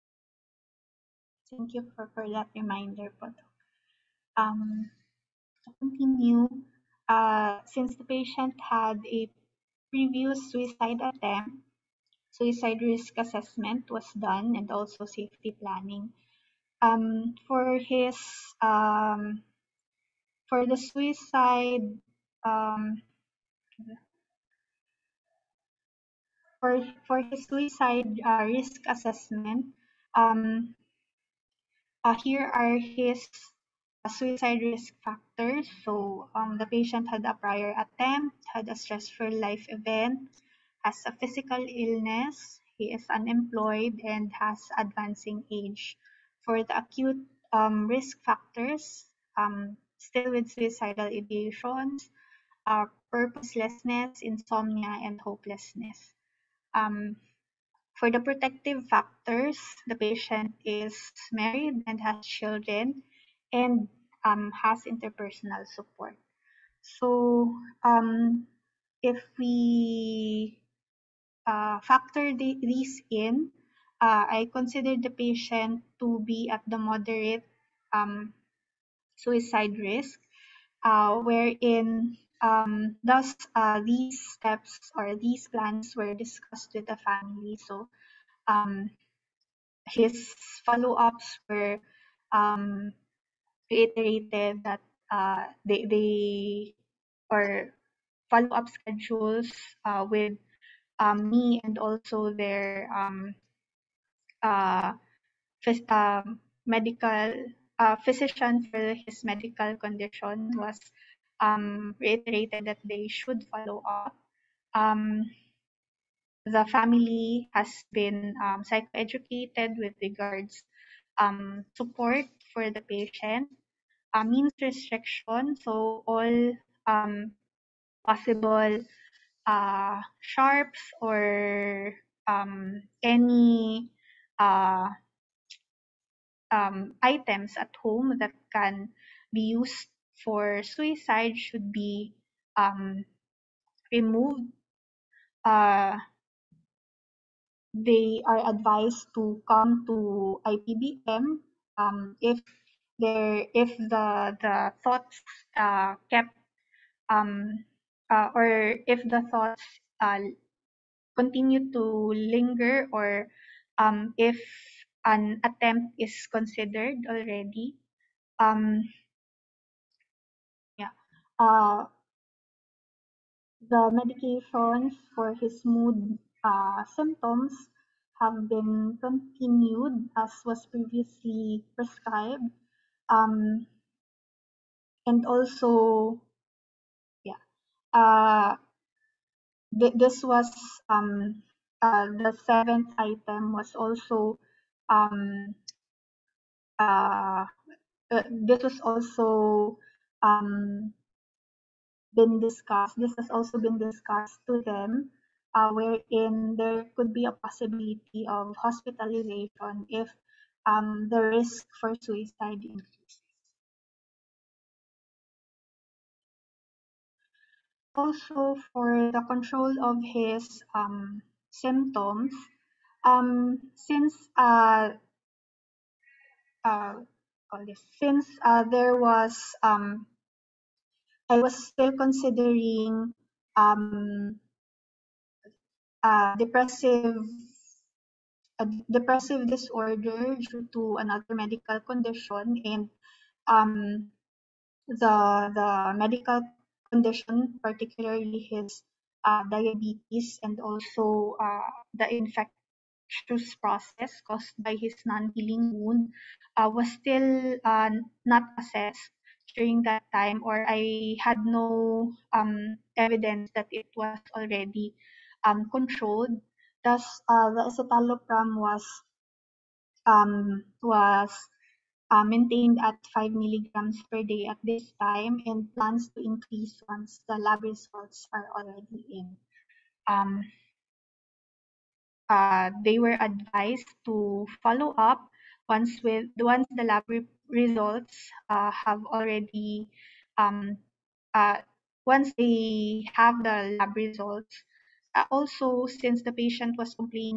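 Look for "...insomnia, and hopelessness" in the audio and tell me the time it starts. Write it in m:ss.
0:54.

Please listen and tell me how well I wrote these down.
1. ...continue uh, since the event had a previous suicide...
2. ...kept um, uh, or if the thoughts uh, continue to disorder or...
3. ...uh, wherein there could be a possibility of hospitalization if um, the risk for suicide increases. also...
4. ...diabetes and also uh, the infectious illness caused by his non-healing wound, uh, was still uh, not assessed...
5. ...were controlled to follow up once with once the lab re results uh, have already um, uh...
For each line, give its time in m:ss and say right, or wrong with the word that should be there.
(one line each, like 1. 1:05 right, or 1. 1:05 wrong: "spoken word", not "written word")
1. 0:05 wrong: "patient", not "event"
2. 2:36 wrong: "linger", not "disorder"
3. 3:25 right
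4. 4:09 wrong: "process", not "illness"
5. 4:42 wrong: "advised", not "controlled".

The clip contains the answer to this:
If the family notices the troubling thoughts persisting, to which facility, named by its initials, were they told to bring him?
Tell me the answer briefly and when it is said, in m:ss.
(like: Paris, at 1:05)
IPBM, at 2:30.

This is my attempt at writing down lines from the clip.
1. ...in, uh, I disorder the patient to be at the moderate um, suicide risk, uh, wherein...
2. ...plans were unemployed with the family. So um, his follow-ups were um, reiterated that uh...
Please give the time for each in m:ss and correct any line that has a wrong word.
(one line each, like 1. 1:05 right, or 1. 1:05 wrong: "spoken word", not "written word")
1. 1:13 wrong: "consider", not "disorder"
2. 1:25 wrong: "discussed", not "unemployed".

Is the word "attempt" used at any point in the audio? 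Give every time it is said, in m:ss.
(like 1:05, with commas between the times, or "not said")
0:10, 0:37, 2:45.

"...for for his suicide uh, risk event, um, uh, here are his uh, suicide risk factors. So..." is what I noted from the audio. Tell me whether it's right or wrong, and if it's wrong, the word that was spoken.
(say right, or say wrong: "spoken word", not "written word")
wrong: "assessment", not "event".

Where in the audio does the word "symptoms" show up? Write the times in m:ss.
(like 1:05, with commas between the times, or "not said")
2:56, 3:41.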